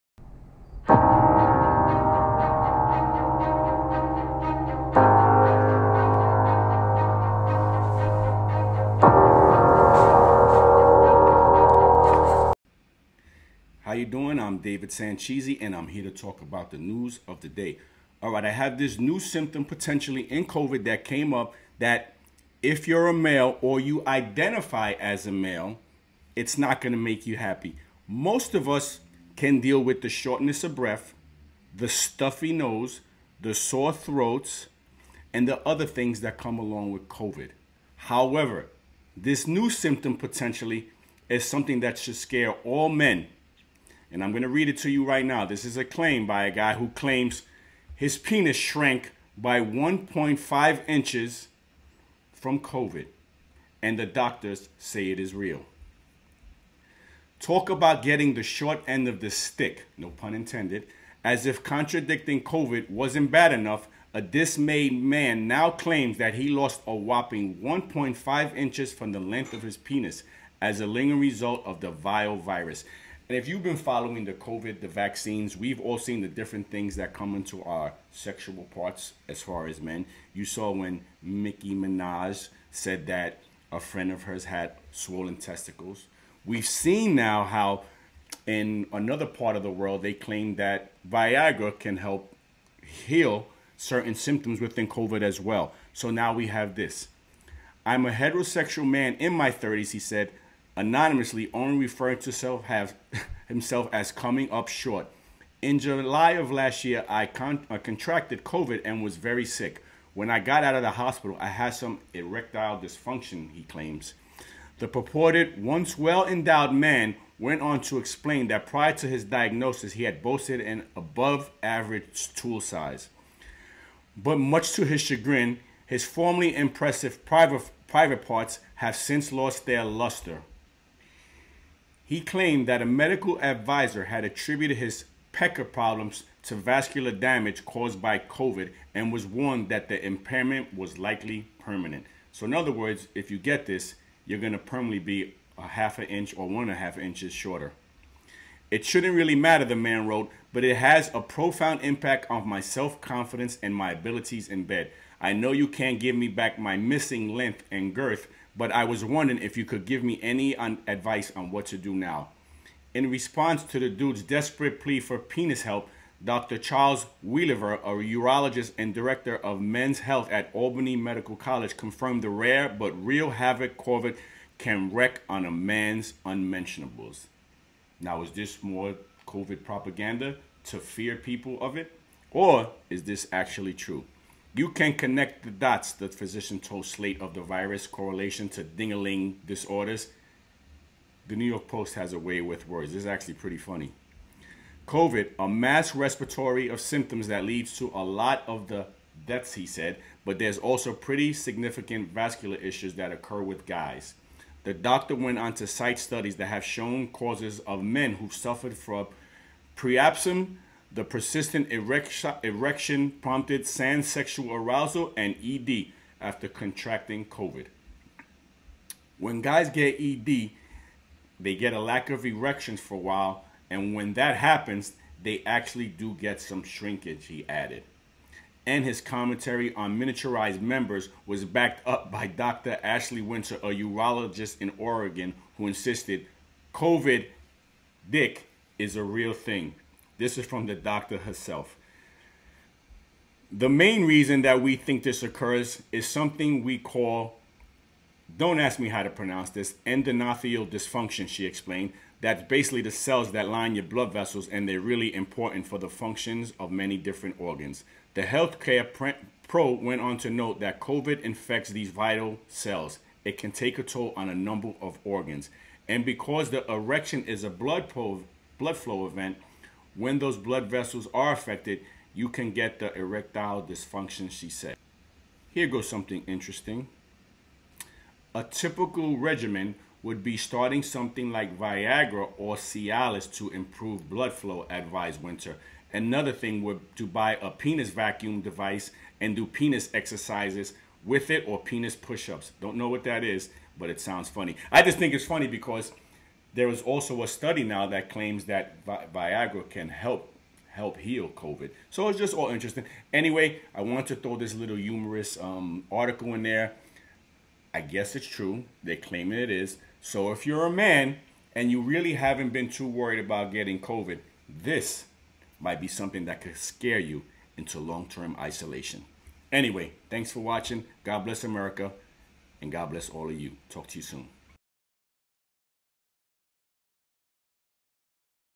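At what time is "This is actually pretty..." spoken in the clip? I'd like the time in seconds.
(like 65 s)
192 s.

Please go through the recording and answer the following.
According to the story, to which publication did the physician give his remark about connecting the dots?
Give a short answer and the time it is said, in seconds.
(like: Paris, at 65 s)
Slate, at 186 s.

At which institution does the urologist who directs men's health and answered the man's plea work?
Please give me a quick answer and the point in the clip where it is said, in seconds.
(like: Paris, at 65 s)
Albany Medical College, at 170 s.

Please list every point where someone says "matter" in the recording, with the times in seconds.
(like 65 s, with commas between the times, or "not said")
149 s.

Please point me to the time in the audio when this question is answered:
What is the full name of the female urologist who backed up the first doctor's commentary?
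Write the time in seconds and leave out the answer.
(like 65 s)
232 s.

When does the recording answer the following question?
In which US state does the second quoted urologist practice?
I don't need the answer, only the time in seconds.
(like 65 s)
234 s.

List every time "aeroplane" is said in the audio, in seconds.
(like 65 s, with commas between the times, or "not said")
not said.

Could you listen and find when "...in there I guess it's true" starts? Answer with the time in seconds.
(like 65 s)
306 s.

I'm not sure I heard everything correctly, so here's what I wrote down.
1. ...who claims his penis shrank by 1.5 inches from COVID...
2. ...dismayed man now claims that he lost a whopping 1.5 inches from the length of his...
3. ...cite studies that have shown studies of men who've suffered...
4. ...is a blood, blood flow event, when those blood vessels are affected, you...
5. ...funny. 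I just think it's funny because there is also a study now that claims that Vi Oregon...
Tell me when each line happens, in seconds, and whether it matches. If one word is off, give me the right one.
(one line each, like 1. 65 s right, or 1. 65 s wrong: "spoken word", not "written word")
1. 46 s right
2. 64 s right
3. 205 s wrong: "causes", not "studies"
4. 267 s right
5. 294 s wrong: "Viagra", not "Oregon".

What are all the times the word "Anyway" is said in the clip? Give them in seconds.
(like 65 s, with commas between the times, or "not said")
303 s, 319 s.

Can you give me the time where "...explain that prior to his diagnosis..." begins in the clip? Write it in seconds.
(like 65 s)
117 s.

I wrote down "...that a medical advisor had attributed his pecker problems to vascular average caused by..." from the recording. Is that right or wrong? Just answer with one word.
wrong.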